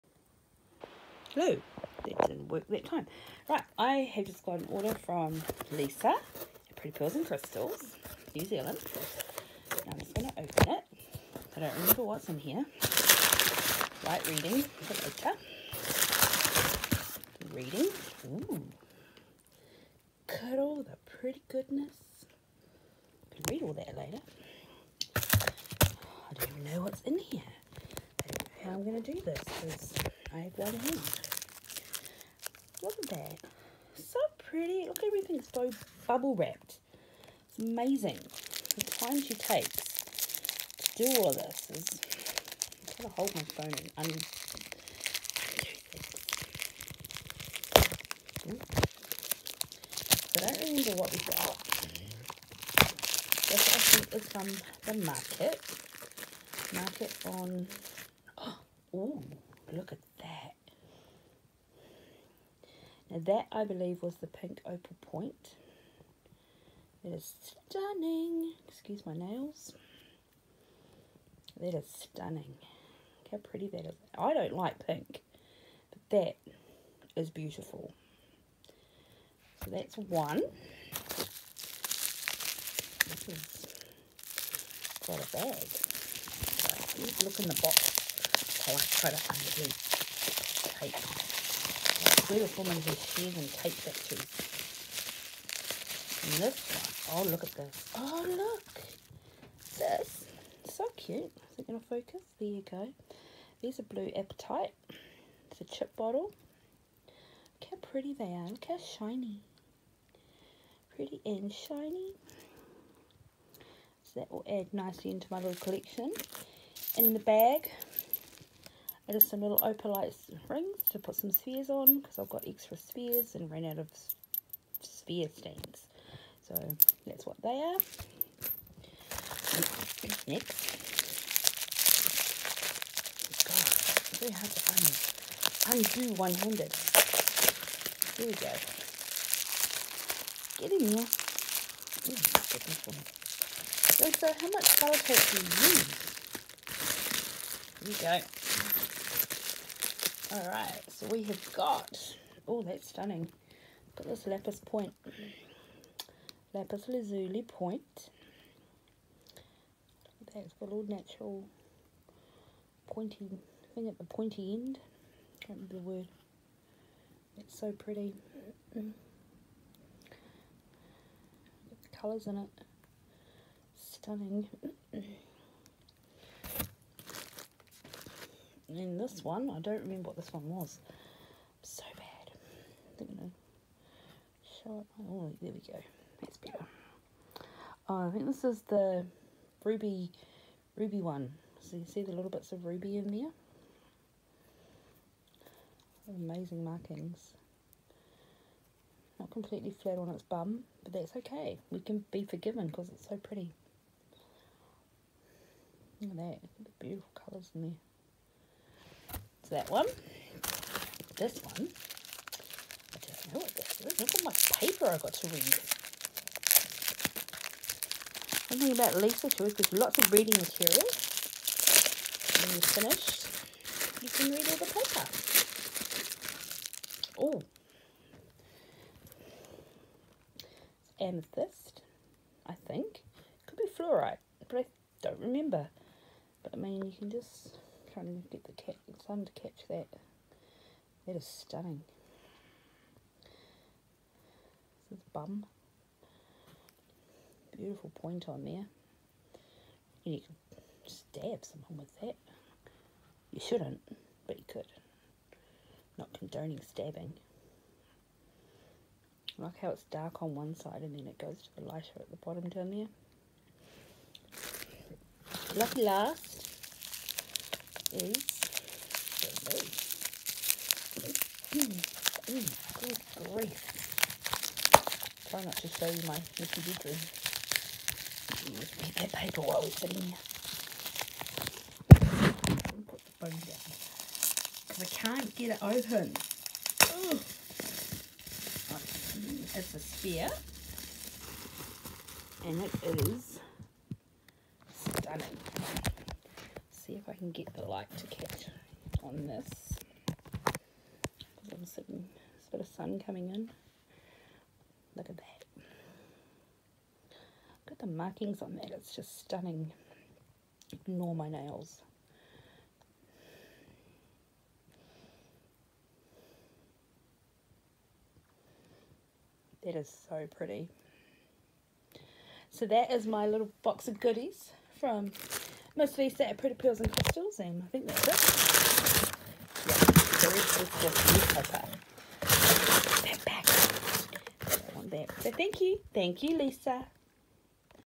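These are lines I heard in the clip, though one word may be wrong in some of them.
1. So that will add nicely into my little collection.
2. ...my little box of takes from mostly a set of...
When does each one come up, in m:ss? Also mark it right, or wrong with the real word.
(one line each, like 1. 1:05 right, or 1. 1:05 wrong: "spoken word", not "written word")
1. 1:54 right
2. 5:23 wrong: "goodies", not "takes".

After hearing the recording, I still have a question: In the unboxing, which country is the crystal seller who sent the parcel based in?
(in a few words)
New Zealand.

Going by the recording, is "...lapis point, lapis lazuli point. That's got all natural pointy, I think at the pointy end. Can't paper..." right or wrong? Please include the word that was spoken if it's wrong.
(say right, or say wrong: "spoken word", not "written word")
wrong: "remember", not "paper".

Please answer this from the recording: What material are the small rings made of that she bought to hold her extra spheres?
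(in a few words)
Opalite.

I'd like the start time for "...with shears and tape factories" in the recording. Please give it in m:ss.
1:32.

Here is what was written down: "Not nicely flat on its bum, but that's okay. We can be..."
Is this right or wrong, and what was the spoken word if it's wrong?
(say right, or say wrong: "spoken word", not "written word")
wrong: "completely", not "nicely".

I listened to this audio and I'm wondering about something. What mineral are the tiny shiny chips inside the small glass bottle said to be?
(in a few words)
Blue apatite.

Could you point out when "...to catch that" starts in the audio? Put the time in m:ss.
3:59.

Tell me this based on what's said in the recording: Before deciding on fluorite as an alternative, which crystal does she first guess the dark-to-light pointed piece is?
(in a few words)
Amethyst.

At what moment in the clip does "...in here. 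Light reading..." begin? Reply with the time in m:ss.
0:12.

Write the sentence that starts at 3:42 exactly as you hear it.
When you're finished, you can read all the paper.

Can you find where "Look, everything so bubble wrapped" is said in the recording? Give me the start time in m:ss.
0:34.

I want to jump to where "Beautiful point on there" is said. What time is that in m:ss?
4:07.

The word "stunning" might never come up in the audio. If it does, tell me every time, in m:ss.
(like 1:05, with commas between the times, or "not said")
1:07, 1:11, 2:32, 2:53, 4:01, 4:54, 5:09.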